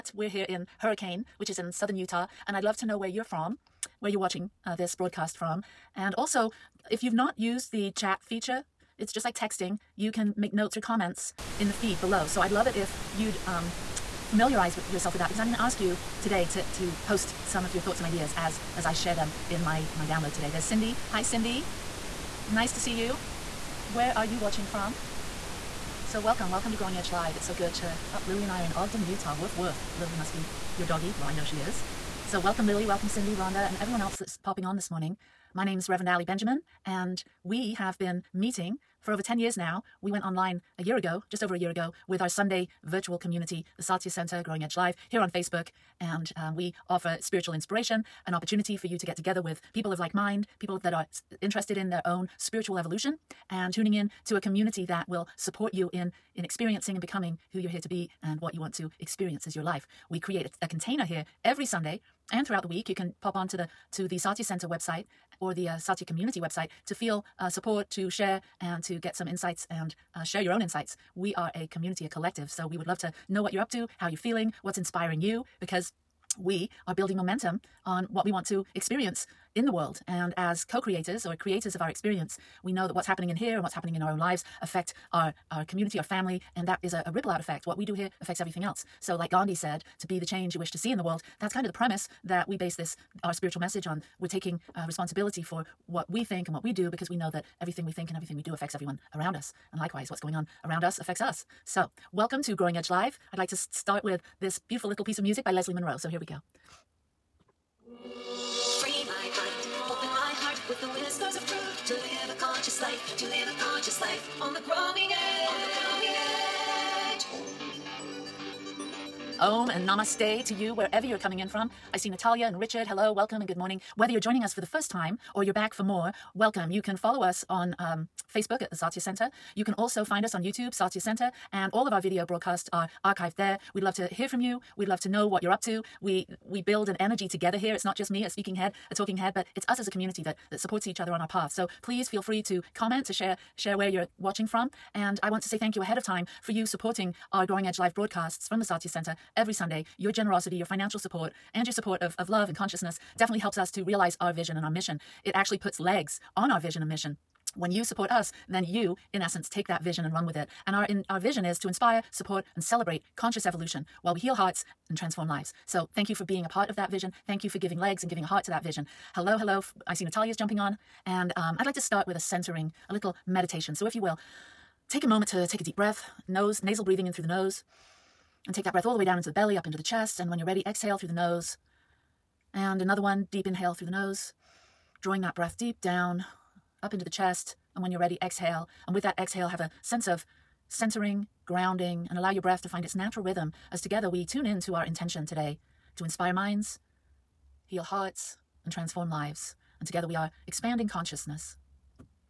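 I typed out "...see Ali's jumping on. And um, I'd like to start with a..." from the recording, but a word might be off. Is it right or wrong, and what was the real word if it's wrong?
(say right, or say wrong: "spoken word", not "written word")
wrong: "Natalia", not "Ali".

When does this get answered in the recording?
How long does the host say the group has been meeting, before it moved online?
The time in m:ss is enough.
0:39.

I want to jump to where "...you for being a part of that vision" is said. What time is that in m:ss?
2:46.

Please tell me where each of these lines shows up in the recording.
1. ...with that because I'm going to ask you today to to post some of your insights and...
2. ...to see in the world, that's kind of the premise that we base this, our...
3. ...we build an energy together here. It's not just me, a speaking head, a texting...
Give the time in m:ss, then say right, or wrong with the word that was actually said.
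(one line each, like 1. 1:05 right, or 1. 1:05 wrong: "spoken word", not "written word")
1. 0:15 wrong: "thoughts", not "insights"
2. 1:30 right
3. 2:16 wrong: "talking", not "texting".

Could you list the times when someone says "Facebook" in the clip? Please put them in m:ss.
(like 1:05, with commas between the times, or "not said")
0:45, 2:08.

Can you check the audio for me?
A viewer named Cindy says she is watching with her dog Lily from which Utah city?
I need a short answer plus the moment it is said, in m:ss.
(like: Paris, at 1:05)
Ogden, at 0:28.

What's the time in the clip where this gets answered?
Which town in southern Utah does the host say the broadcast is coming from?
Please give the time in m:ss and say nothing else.
0:00.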